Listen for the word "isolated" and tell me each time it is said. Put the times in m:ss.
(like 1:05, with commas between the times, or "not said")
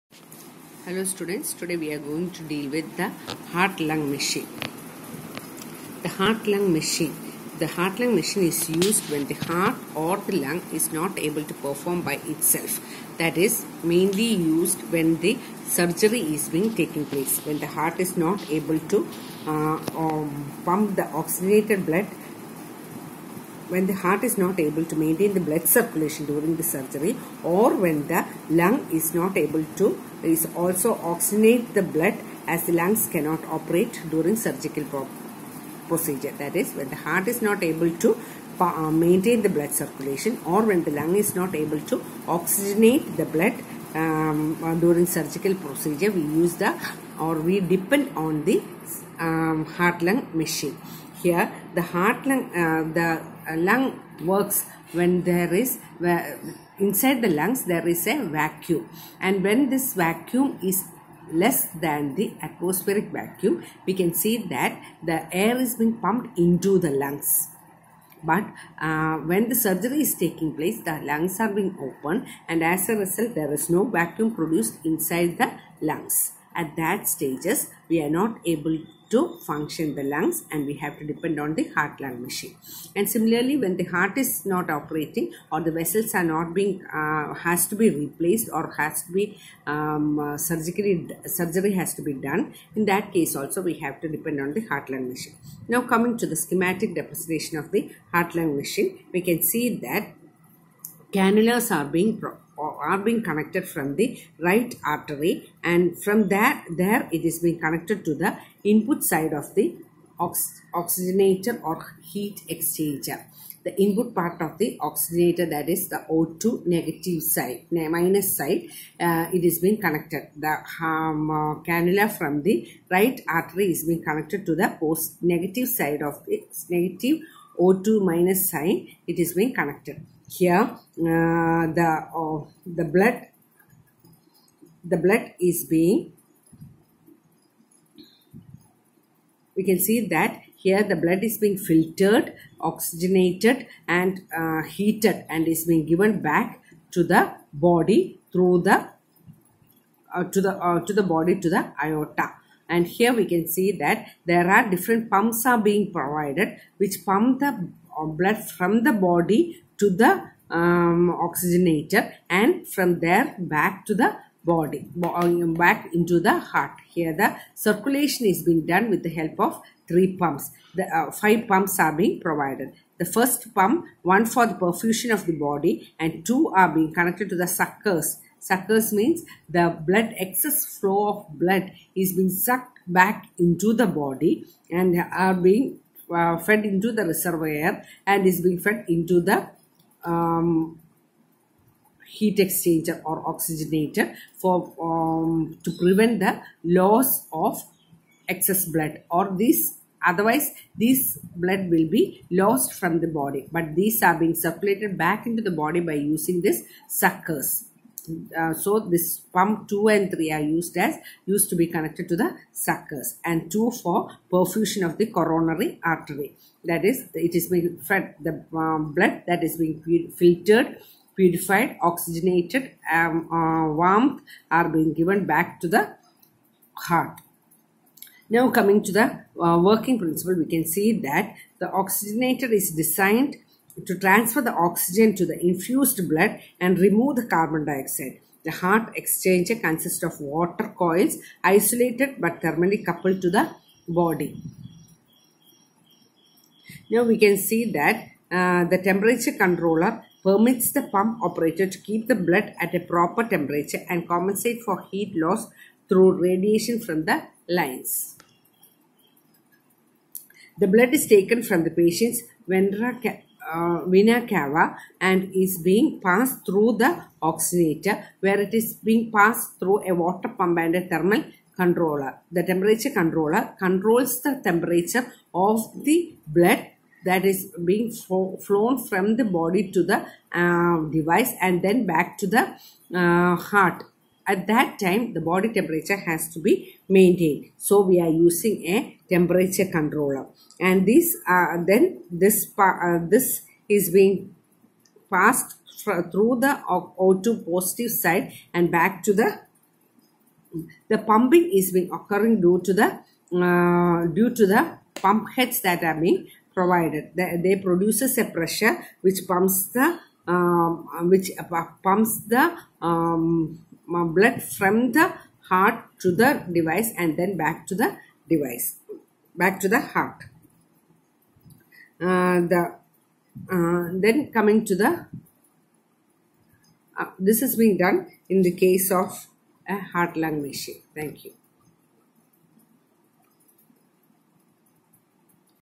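4:01.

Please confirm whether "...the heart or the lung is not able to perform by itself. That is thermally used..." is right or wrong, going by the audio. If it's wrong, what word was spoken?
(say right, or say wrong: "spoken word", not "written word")
wrong: "mainly", not "thermally".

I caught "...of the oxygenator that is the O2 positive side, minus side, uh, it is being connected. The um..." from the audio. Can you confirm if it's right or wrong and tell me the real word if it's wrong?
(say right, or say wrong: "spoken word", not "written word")
wrong: "negative", not "positive".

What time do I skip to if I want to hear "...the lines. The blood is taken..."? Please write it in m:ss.
4:17.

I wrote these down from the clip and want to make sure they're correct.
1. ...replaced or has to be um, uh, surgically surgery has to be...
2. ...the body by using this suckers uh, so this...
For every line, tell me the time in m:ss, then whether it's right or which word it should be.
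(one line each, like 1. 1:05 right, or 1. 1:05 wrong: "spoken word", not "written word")
1. 1:28 right
2. 3:25 right.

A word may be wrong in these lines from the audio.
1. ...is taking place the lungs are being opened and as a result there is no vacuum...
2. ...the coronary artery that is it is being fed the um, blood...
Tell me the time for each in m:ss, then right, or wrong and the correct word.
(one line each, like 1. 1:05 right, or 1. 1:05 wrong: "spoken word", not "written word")
1. 1:10 right
2. 3:34 right.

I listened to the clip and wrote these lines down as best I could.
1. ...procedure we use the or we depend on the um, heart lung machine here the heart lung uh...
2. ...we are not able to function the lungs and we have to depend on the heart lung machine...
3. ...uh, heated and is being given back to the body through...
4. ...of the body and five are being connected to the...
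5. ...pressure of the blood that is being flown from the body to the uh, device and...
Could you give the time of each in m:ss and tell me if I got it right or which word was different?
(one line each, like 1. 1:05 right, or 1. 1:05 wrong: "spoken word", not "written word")
1. 0:45 right
2. 1:17 right
3. 2:24 right
4. 2:55 wrong: "two", not "five"
5. 4:34 wrong: "temperature", not "pressure".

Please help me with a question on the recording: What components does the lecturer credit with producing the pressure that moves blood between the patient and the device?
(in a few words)
pump heads.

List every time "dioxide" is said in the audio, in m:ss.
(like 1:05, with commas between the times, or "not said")
3:57.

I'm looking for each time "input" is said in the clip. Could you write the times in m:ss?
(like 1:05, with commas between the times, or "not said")
1:48, 1:53.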